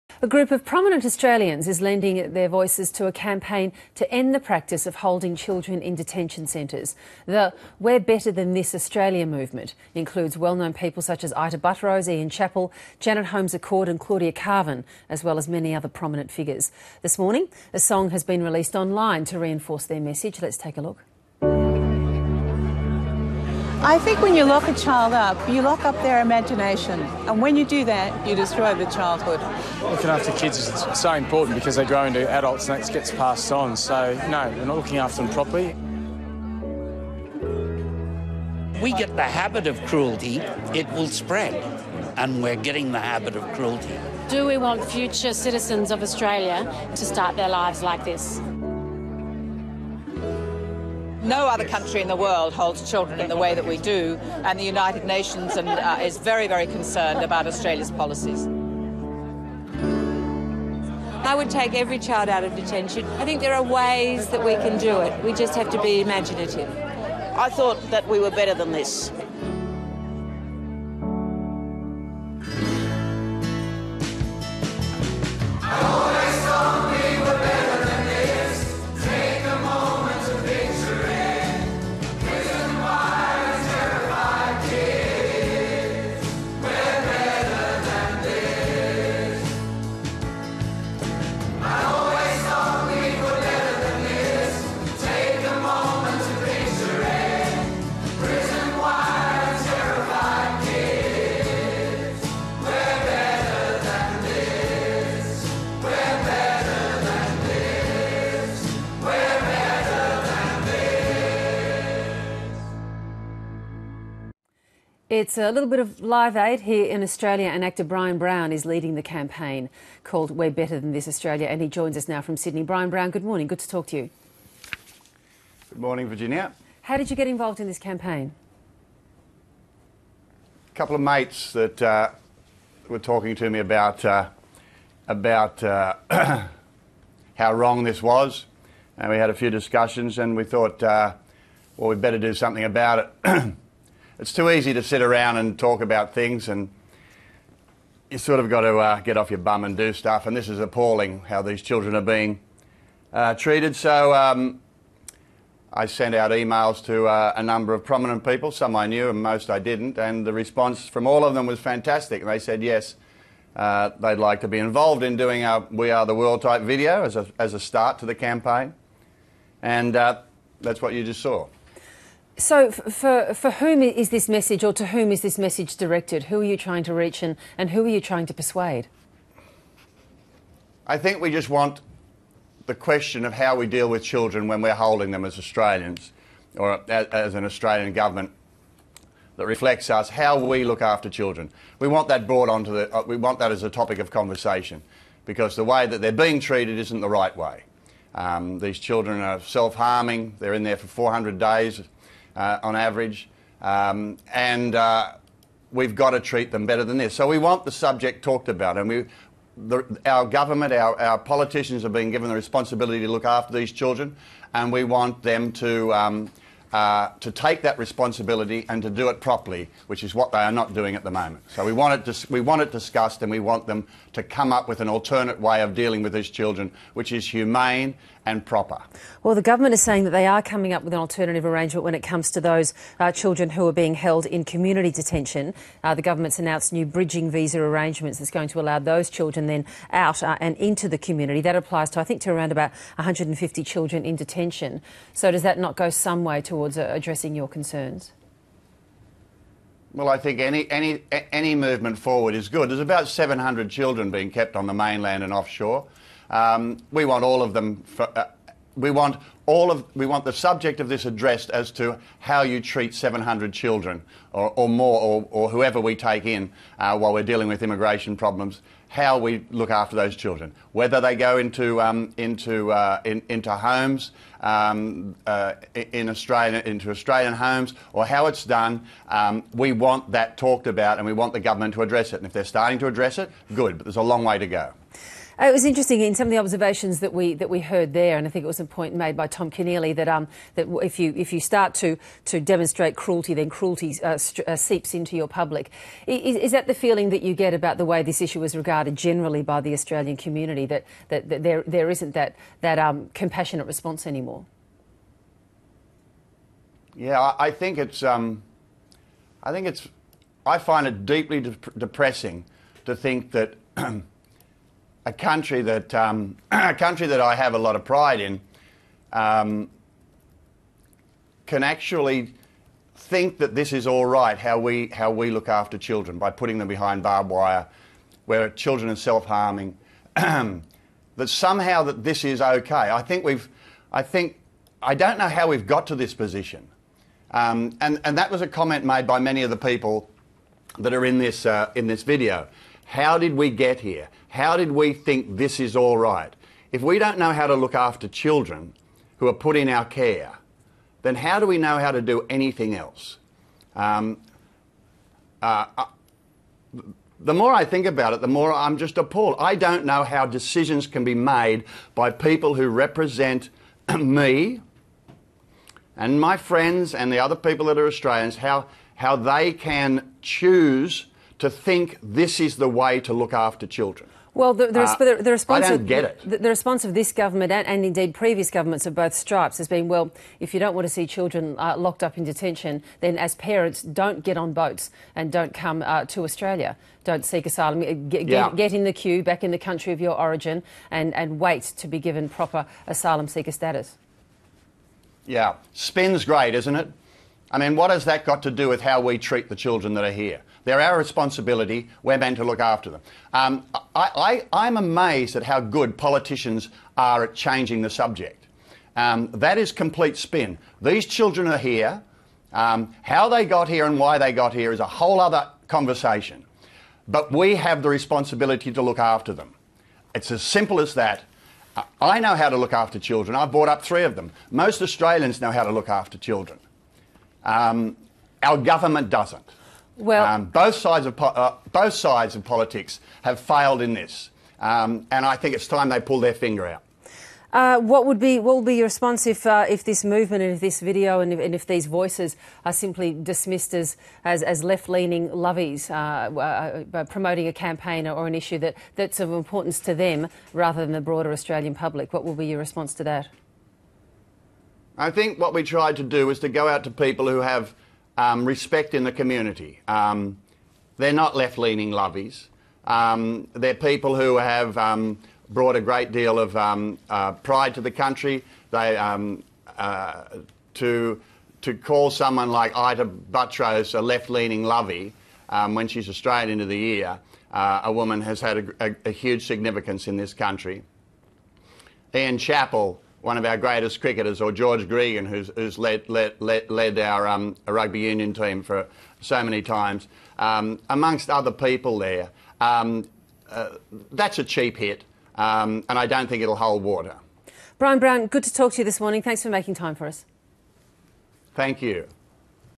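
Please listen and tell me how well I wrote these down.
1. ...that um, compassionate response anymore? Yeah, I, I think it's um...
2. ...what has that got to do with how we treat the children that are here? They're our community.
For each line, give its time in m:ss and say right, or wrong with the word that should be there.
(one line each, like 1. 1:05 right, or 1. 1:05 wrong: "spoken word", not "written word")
1. 5:02 right
2. 6:37 wrong: "responsibility", not "community".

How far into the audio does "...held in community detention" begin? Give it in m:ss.
3:53.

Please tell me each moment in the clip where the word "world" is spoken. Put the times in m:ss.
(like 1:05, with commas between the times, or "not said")
0:52, 2:46.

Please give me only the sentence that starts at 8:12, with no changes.
Um, uh, that's a cheap hit, um, and I don't think it'll hold water.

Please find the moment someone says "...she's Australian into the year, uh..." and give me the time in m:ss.
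7:55.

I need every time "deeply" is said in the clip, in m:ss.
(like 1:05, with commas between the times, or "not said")
5:11.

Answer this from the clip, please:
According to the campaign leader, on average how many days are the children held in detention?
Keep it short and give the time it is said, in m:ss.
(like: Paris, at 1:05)
400, at 3:20.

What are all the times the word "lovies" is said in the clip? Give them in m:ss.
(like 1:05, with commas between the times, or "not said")
7:25, 7:41.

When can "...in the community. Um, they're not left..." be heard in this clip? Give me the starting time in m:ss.
7:38.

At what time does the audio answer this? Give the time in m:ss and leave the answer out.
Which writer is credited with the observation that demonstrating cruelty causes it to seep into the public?
4:49.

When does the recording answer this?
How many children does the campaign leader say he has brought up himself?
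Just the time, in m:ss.
7:03.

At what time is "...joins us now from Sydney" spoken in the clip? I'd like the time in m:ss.
2:01.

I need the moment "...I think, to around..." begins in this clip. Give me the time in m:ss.
4:01.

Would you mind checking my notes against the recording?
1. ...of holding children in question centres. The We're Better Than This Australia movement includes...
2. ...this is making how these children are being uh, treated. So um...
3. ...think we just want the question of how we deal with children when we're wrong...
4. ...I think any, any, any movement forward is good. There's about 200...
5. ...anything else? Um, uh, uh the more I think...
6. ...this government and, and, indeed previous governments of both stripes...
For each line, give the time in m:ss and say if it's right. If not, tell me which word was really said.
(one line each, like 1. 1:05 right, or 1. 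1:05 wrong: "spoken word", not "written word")
1. 0:04 wrong: "detention", not "question"
2. 2:30 wrong: "appalling", not "making"
3. 3:00 wrong: "holding", not "wrong"
4. 4:10 wrong: "700", not "200"
5. 5:52 right
6. 6:16 right.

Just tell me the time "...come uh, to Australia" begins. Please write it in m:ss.
6:25.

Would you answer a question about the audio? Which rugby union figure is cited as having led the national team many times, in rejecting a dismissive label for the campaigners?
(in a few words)
George Gregan.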